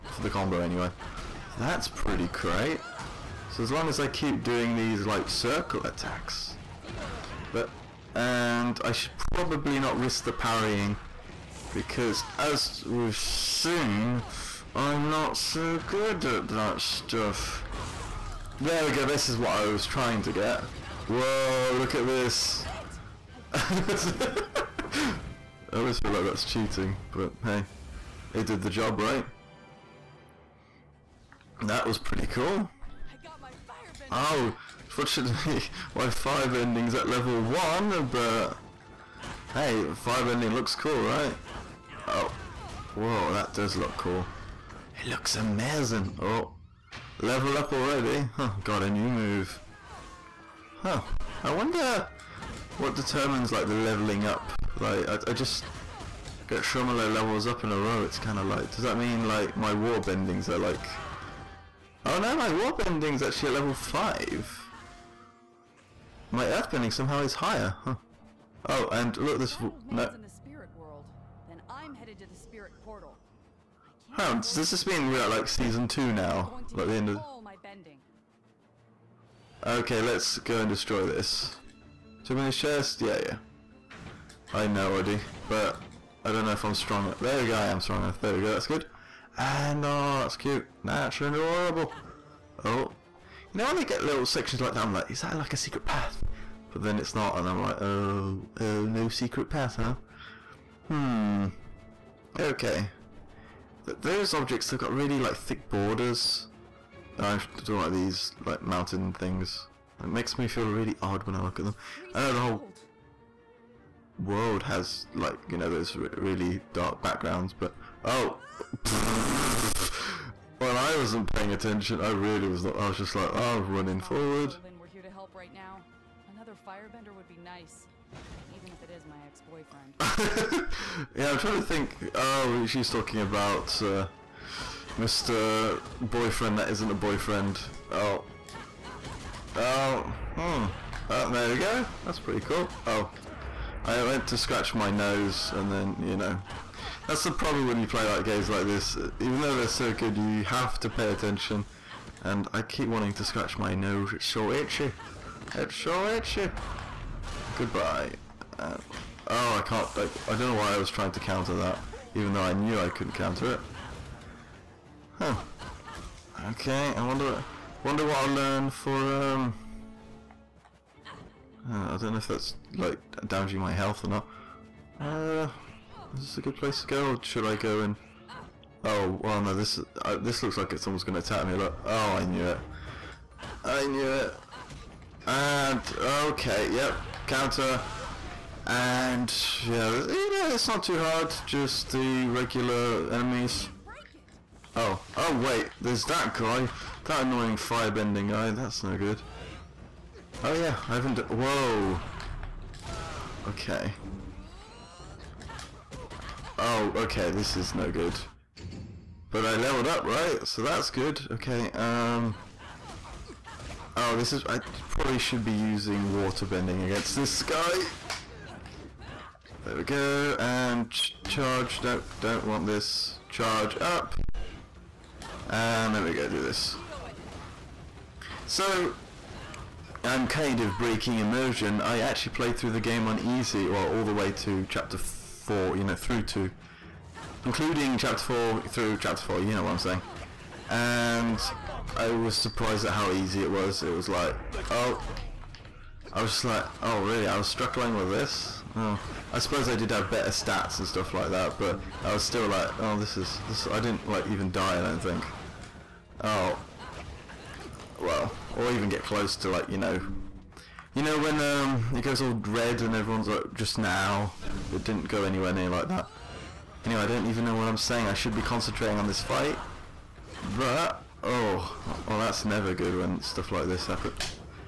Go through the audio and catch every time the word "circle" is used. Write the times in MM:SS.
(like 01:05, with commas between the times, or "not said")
00:05.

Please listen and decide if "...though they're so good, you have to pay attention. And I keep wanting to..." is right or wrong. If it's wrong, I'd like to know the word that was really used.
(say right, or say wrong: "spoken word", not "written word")
right.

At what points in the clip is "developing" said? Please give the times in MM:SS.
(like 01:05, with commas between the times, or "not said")
not said.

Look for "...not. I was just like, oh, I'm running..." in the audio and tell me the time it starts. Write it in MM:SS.
02:02.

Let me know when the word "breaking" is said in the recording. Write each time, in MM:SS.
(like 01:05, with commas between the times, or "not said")
03:50.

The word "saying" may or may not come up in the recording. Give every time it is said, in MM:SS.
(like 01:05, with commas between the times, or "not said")
03:59, 04:27.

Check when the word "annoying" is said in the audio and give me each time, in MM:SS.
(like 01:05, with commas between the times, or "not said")
03:17.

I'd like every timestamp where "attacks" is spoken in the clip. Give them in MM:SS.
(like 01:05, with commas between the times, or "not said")
00:05, 03:01.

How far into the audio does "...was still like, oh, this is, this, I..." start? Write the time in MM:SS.
04:12.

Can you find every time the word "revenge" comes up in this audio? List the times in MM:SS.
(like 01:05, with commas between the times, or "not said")
not said.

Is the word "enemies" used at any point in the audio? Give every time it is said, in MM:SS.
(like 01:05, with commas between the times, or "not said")
03:13.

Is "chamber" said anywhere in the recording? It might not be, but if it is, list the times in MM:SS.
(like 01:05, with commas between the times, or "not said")
not said.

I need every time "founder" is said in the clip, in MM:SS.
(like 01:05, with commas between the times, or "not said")
not said.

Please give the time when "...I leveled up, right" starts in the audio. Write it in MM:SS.
03:29.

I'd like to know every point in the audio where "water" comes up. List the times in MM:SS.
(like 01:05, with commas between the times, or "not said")
00:59, 03:36.